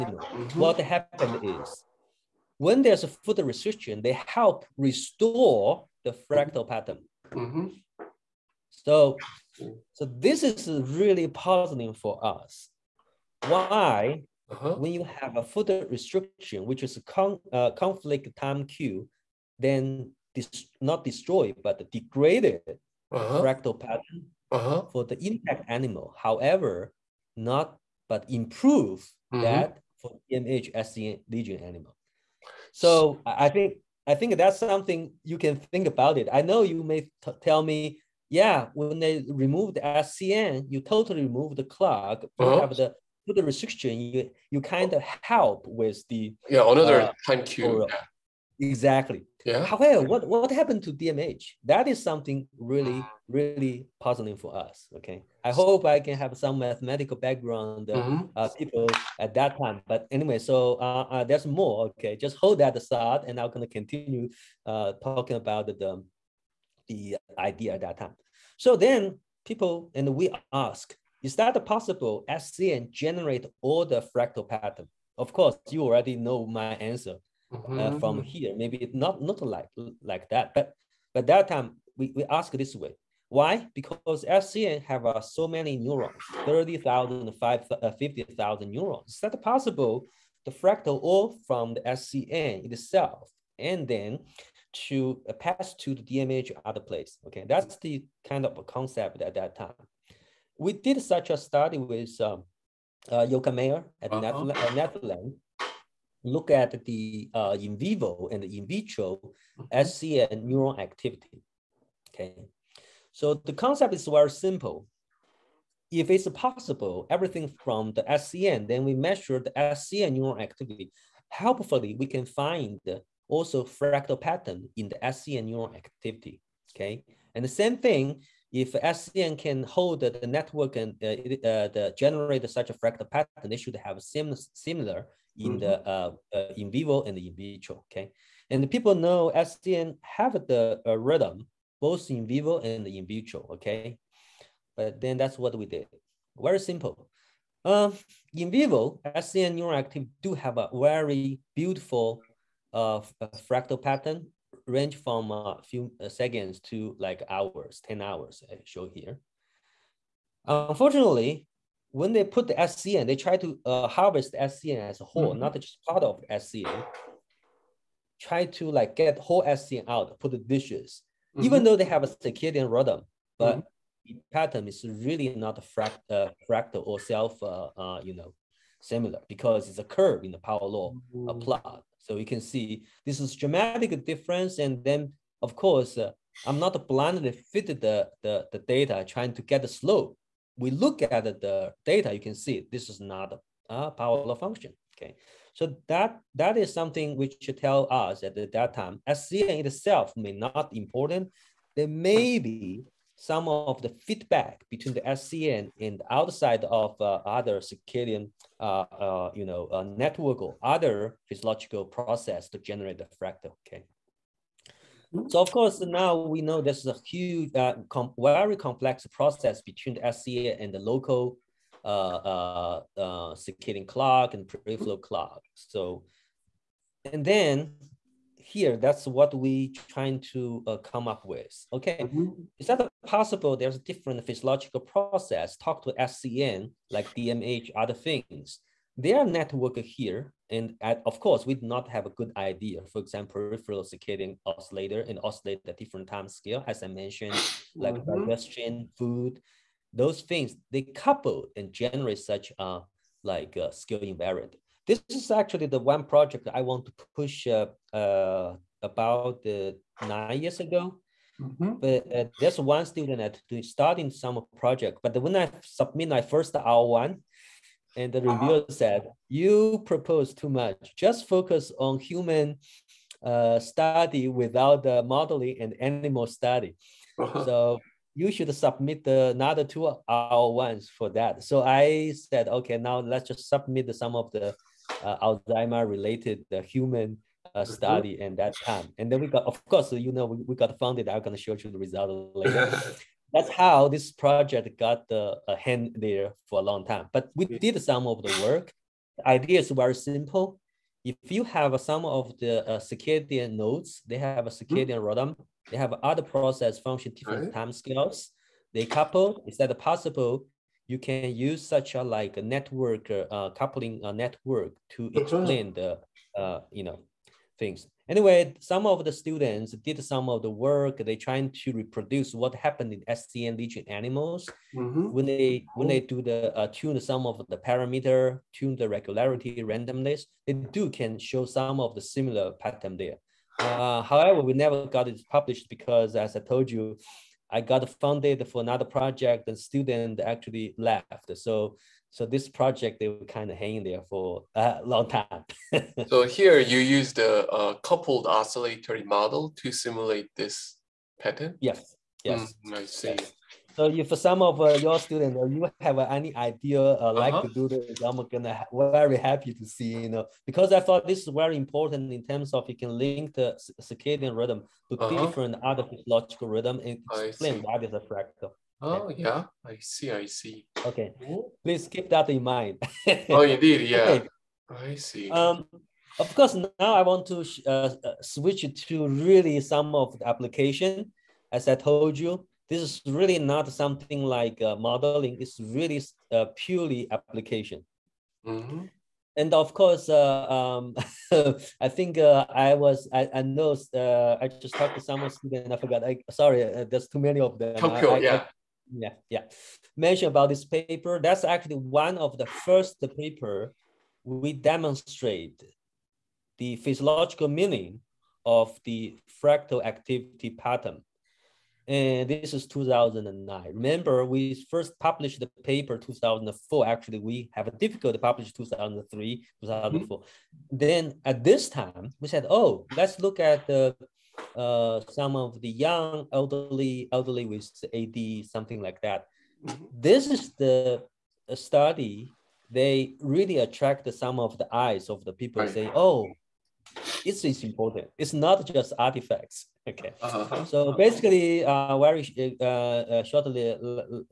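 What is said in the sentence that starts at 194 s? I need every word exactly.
Okay, so that that is something which tell us at that time, SCN itself may not important.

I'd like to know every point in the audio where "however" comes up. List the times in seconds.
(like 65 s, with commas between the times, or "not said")
26 s, 49 s, 334 s.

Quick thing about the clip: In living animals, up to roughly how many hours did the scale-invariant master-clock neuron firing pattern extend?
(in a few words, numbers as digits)
10 hours.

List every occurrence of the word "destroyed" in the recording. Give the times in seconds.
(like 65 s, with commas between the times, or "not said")
21 s.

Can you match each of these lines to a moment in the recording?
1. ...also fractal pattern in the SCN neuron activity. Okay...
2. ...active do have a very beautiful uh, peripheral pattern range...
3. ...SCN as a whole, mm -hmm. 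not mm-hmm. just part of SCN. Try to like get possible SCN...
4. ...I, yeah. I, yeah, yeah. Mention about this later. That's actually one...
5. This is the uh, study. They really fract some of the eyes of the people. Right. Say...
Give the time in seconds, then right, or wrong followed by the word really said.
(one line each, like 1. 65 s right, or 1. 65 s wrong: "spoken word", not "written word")
1. 123 s right
2. 149 s wrong: "fractal", not "peripheral"
3. 164 s wrong: "whole", not "possible"
4. 398 s wrong: "paper", not "later"
5. 429 s wrong: "attract", not "fract".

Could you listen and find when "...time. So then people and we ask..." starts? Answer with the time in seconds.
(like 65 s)
67 s.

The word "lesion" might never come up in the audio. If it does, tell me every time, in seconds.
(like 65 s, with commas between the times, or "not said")
31 s, 323 s.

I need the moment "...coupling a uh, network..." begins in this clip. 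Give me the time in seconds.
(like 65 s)
313 s.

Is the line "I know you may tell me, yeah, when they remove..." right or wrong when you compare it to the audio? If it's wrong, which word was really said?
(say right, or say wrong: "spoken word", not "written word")
right.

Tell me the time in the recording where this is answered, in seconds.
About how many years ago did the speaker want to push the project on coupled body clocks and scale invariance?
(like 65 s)
260 s.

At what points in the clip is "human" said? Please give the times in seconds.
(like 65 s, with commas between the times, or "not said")
272 s, 286 s.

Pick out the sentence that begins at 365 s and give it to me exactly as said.
different other physiological rhythm and explain what is a fractal.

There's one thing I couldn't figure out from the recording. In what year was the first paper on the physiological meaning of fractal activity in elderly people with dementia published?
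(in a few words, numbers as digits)
2009.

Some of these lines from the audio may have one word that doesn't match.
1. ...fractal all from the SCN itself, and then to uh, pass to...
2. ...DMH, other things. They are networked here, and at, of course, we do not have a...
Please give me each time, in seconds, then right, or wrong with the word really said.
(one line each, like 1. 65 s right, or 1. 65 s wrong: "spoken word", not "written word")
1. 90 s right
2. 237 s right.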